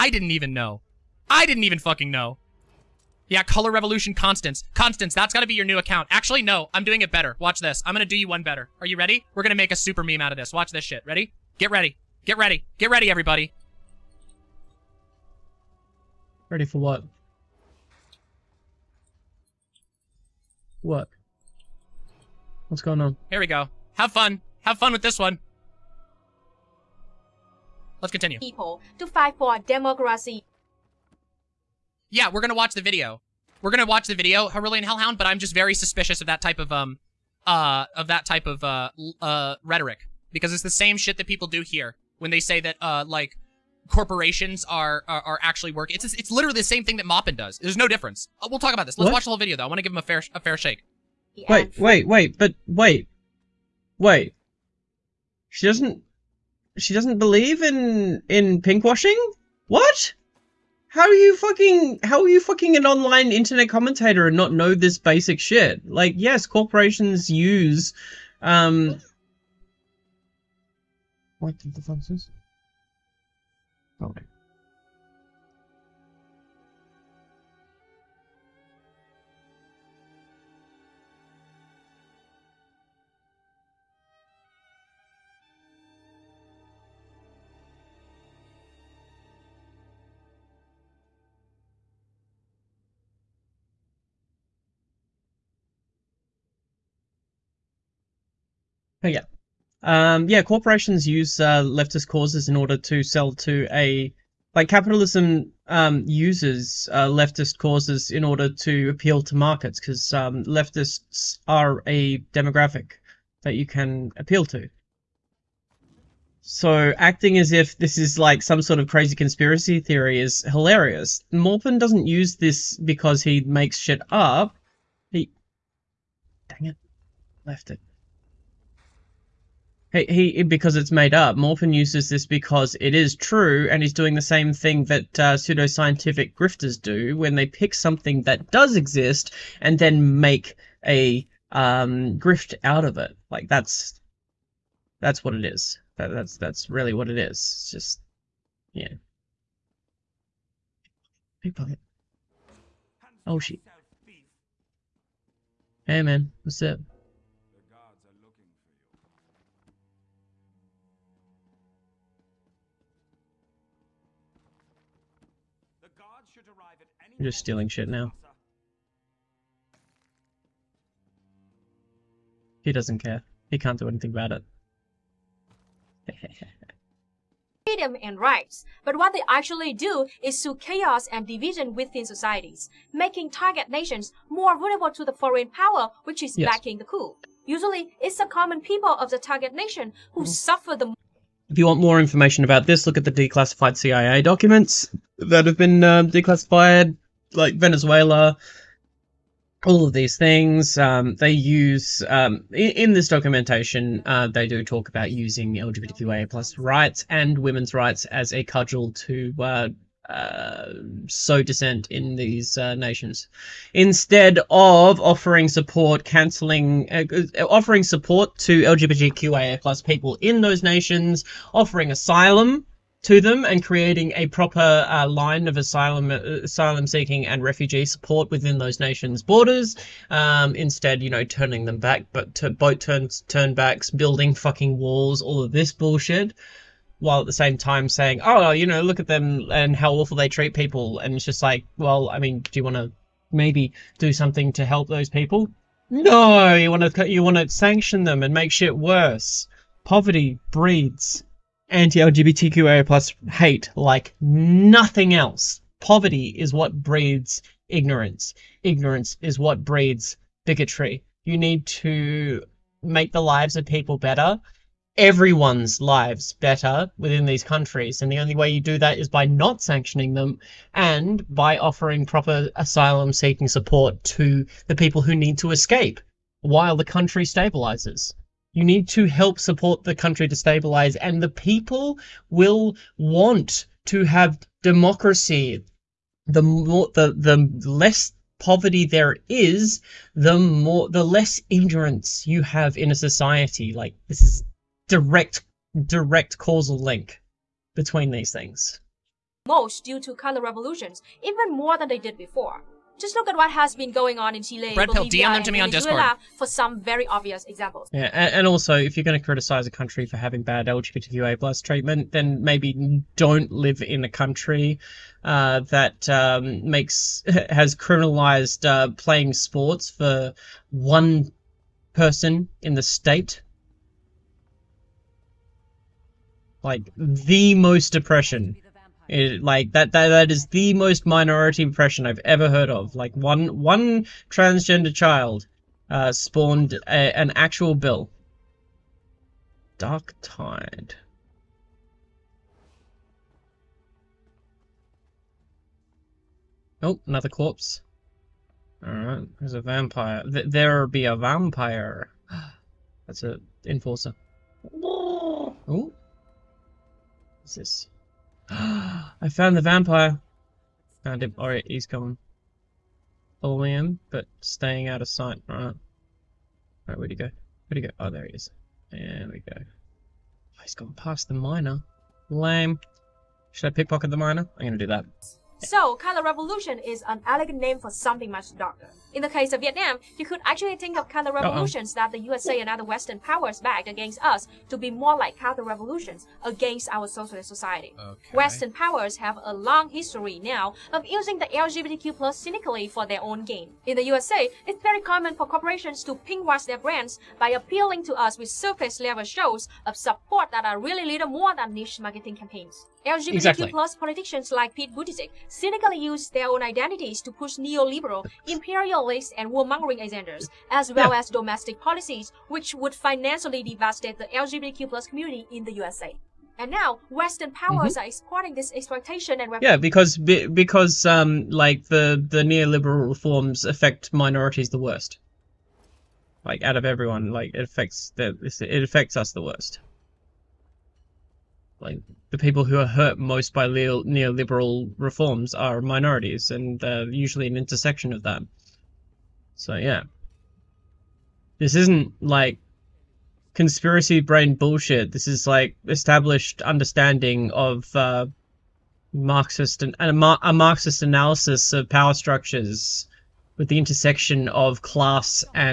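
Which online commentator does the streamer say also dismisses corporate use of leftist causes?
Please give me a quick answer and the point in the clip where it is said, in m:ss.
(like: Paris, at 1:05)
Moppin, at 0:47.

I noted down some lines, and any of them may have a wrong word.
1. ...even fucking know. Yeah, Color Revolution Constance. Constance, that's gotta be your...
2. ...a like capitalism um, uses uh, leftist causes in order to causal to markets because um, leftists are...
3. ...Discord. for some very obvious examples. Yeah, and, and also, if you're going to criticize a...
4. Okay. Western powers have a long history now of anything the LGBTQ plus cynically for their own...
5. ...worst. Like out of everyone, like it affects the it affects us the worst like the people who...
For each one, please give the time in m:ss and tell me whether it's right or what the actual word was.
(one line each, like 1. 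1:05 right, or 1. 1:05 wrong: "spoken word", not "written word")
1. 0:01 right
2. 1:43 wrong: "appeal", not "causal"
3. 5:05 right
4. 6:28 wrong: "using", not "anything"
5. 7:04 right.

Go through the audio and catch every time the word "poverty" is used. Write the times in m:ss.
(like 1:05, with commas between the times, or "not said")
4:09, 4:15, 4:48.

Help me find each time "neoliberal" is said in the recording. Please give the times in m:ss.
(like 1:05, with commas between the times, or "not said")
6:47, 7:02, 7:14.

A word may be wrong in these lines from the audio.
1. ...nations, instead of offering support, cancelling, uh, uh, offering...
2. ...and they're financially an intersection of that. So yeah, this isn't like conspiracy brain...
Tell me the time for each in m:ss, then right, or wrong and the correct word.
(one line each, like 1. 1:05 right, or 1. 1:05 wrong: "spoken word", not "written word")
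1. 3:32 right
2. 7:16 wrong: "usually", not "financially".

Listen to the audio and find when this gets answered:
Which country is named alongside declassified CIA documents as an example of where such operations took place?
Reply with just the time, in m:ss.
3:17.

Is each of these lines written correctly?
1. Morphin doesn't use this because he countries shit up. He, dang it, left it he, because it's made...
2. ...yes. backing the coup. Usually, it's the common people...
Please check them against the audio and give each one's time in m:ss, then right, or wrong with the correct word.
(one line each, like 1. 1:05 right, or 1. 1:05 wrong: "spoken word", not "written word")
1. 2:01 wrong: "makes", not "countries"
2. 3:06 right.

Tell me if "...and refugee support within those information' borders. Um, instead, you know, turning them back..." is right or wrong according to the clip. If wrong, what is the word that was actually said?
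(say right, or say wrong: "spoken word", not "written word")
wrong: "nations", not "information".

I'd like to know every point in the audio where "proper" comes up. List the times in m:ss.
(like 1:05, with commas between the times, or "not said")
3:44, 4:32.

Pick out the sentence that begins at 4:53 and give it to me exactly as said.
Like this is direct, direct causal link between these things.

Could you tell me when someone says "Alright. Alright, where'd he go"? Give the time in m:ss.
6:05.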